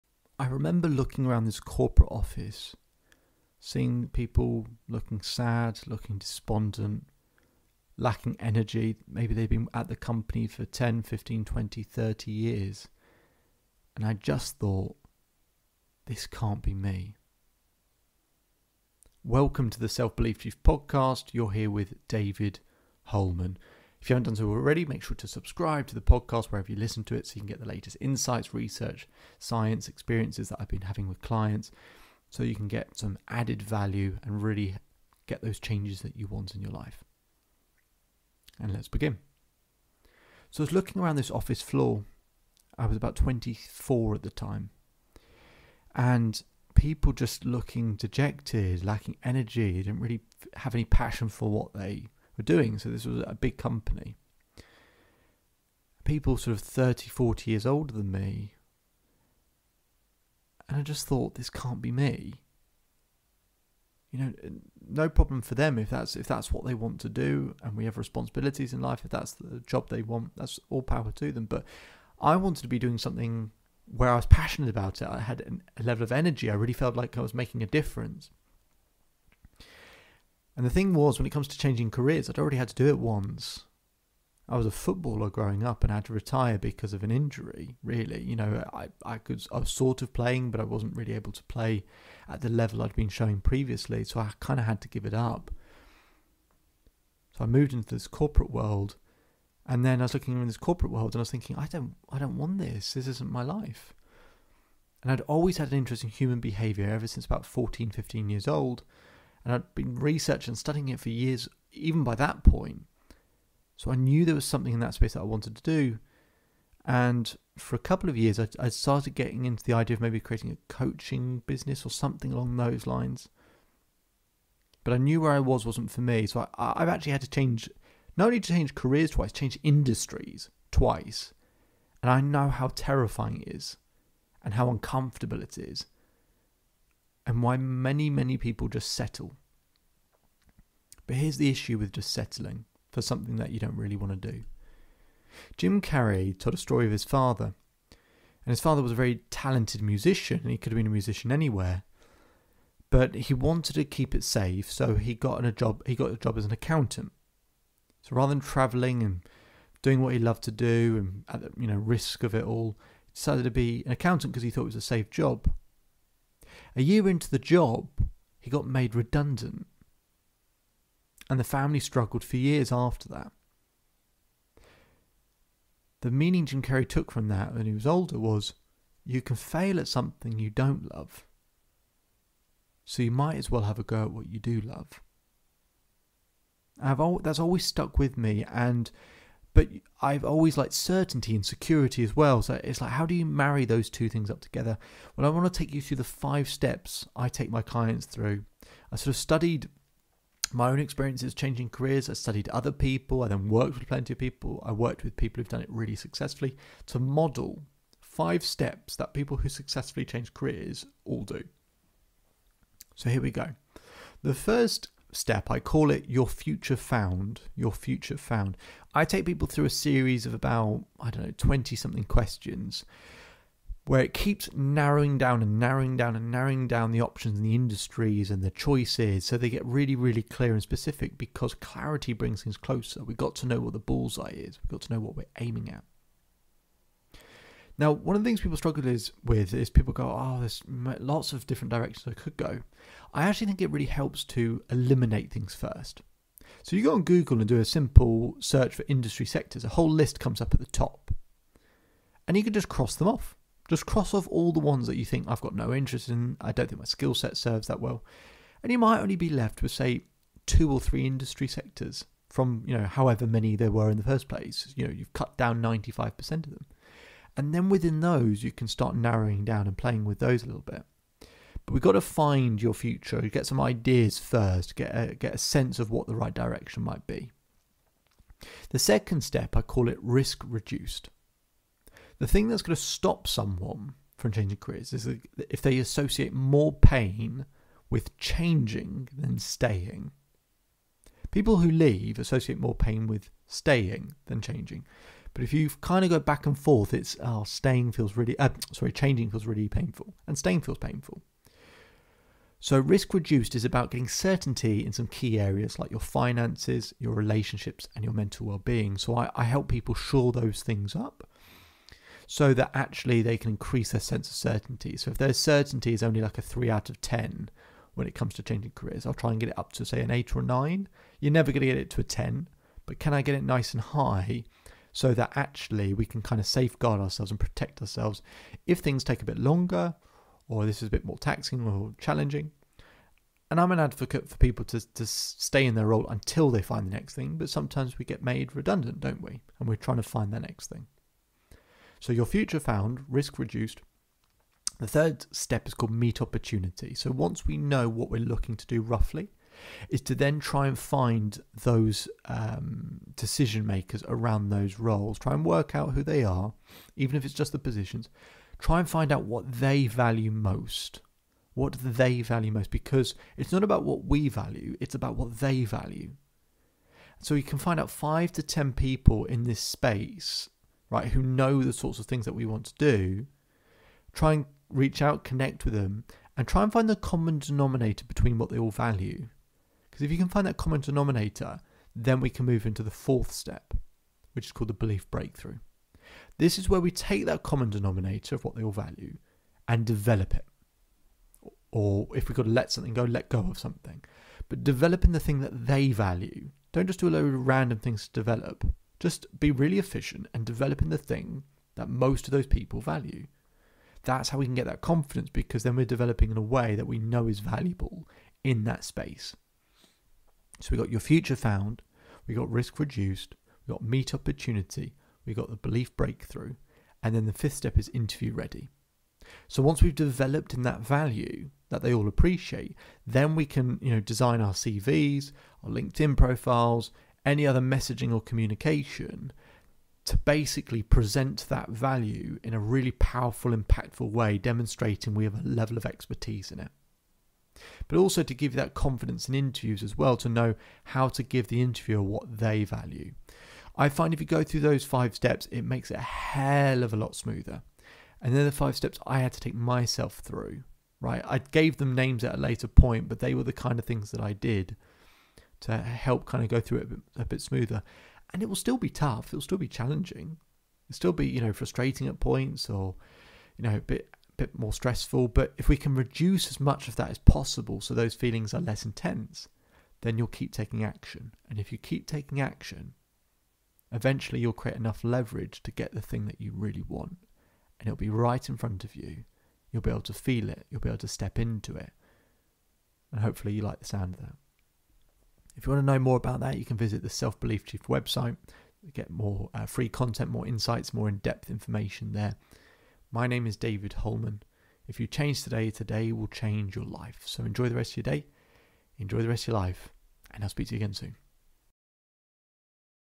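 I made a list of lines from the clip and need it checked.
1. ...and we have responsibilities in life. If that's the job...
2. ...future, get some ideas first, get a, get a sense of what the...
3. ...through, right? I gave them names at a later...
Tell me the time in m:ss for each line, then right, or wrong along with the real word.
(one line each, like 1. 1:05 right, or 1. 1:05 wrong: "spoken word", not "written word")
1. 1:07 right
2. 4:32 right
3. 7:30 right.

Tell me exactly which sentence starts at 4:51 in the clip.
People who leave associate more pain with staying than changing.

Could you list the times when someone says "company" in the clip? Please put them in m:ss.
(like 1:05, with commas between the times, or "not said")
0:09, 0:53.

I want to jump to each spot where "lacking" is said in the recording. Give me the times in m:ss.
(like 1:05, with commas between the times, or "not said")
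0:07, 0:48.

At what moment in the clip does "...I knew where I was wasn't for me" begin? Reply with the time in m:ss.
2:04.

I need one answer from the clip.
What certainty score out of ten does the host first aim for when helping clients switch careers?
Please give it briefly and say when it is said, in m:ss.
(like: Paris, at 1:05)
8, at 5:20.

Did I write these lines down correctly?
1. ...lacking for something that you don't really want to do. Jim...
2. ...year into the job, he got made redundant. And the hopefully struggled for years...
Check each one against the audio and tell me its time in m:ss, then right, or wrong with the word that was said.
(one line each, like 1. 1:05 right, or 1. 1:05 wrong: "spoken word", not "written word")
1. 2:22 wrong: "settling", not "lacking"
2. 2:46 wrong: "family", not "hopefully".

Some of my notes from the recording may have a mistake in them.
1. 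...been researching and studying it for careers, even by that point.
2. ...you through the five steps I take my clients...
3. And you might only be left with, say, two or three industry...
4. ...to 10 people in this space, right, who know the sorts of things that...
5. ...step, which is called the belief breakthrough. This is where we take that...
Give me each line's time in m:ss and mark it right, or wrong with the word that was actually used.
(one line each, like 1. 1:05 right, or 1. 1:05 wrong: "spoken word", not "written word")
1. 1:49 wrong: "years", not "careers"
2. 3:15 right
3. 4:18 right
4. 6:08 right
5. 6:23 right.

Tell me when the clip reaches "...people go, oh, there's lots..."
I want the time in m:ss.
3:59.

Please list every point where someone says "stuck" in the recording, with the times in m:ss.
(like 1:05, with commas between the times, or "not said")
3:07.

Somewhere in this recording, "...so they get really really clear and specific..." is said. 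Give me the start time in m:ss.
3:49.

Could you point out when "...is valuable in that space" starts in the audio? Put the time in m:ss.
6:47.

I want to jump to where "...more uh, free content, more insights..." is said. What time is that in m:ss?
8:09.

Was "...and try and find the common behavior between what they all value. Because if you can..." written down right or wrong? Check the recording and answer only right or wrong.
wrong.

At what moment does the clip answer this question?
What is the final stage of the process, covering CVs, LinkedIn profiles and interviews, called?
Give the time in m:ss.
6:57.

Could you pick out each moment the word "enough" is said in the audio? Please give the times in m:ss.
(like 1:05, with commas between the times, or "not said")
7:54.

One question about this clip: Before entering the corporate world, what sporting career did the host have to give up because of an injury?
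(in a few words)
Footballer.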